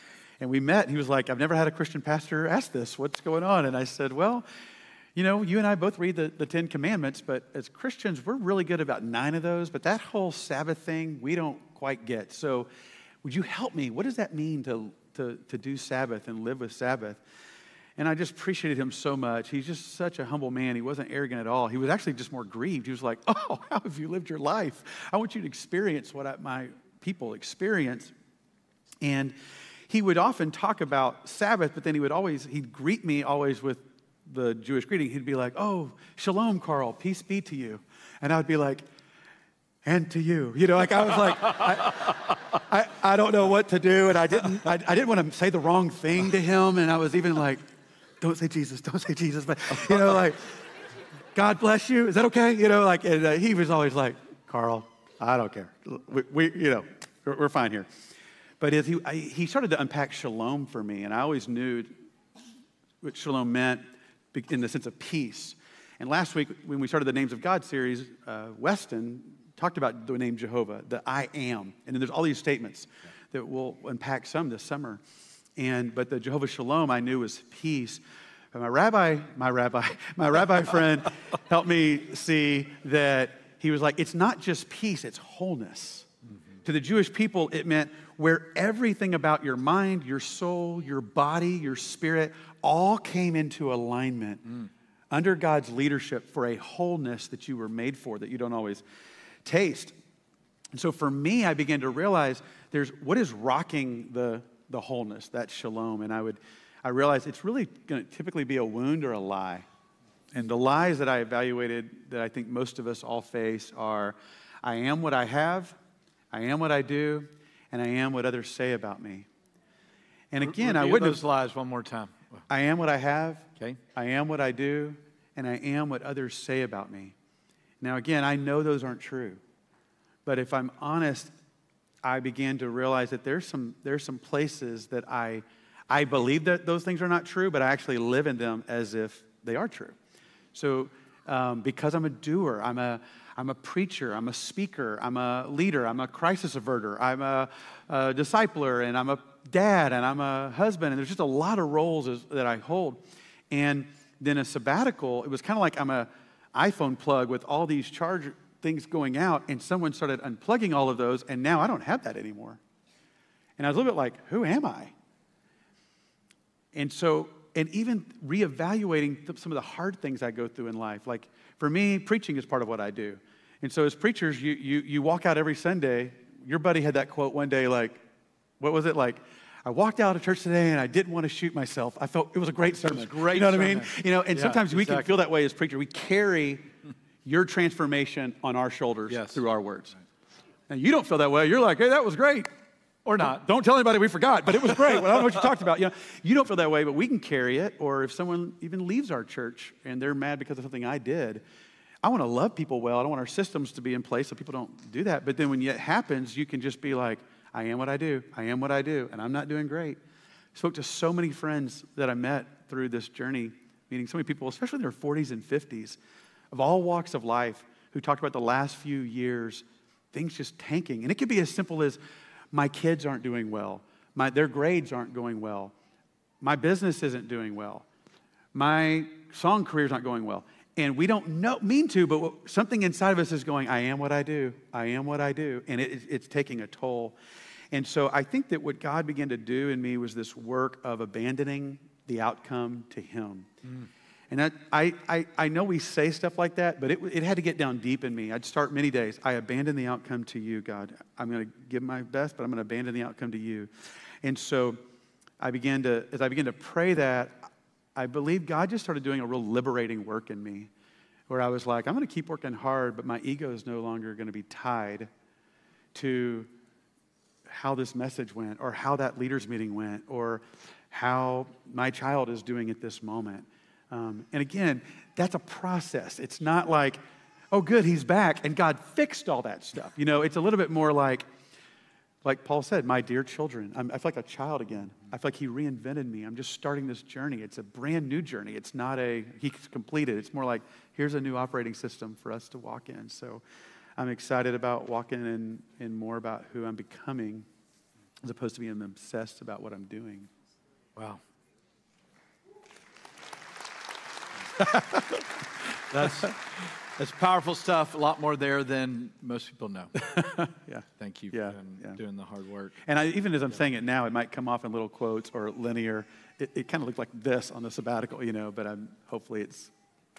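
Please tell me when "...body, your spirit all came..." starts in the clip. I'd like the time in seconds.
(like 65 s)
91 s.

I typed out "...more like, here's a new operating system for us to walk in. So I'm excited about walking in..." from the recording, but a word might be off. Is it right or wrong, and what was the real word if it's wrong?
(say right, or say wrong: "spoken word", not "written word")
right.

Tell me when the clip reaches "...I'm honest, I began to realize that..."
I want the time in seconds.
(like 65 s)
130 s.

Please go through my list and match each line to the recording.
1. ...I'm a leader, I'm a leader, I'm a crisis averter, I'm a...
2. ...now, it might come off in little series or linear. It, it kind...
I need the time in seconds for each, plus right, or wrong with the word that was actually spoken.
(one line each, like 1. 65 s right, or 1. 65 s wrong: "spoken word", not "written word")
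1. 144 s wrong: "speaker", not "leader"
2. 313 s wrong: "quotes", not "series".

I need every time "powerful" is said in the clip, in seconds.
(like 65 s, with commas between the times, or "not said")
307 s.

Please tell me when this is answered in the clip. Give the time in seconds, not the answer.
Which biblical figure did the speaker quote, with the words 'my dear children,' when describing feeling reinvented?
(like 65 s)
282 s.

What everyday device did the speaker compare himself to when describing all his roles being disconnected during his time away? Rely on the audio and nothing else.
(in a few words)
iPhone.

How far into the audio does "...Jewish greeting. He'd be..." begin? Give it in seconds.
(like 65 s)
34 s.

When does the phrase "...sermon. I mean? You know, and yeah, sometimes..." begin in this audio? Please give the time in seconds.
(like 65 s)
183 s.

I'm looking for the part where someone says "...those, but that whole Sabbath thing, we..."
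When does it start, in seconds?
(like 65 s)
9 s.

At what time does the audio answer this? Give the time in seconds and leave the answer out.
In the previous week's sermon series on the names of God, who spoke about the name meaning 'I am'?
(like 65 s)
68 s.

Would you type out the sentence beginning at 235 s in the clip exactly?
And it, it's taking a toll.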